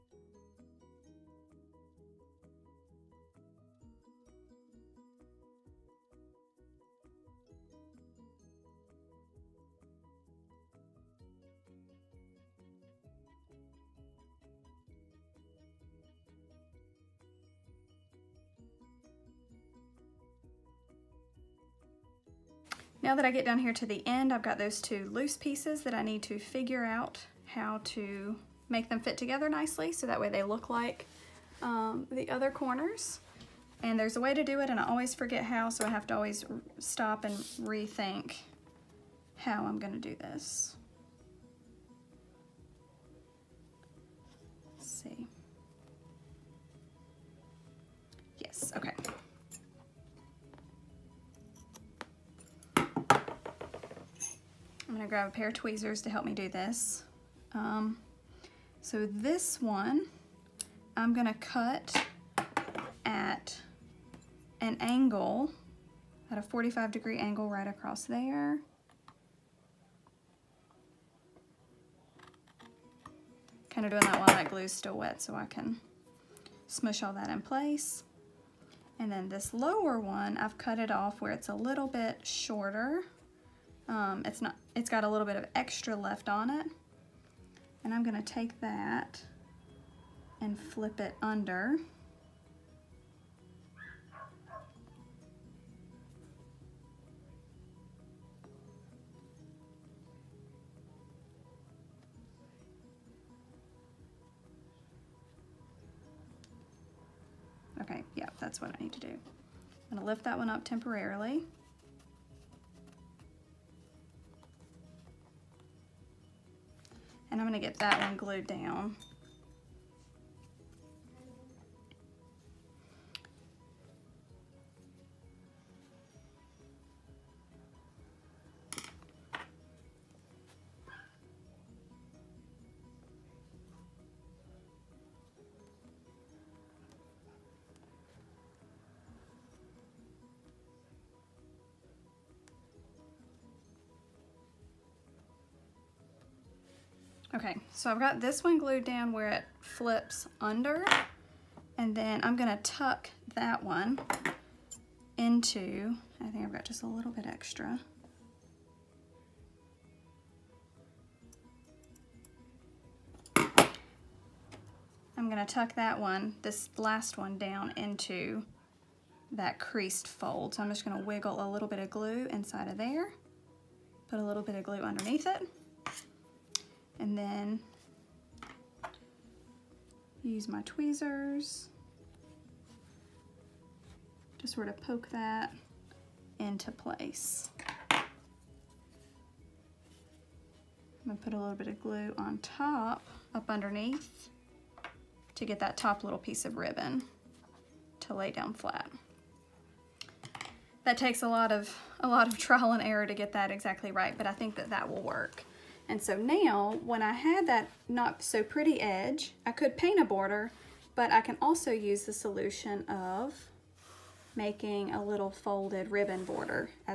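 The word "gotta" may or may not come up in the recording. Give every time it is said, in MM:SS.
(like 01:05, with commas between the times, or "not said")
not said.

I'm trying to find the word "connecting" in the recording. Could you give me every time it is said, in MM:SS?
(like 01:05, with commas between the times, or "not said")
not said.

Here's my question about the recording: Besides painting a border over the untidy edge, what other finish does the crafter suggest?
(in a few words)
folded ribbon border.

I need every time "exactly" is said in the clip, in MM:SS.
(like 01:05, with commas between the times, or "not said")
03:23.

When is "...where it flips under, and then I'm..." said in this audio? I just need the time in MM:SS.
02:29.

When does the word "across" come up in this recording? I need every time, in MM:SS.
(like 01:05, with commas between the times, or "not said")
01:07.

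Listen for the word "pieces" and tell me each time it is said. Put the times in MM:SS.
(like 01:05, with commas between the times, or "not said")
00:25, 03:16.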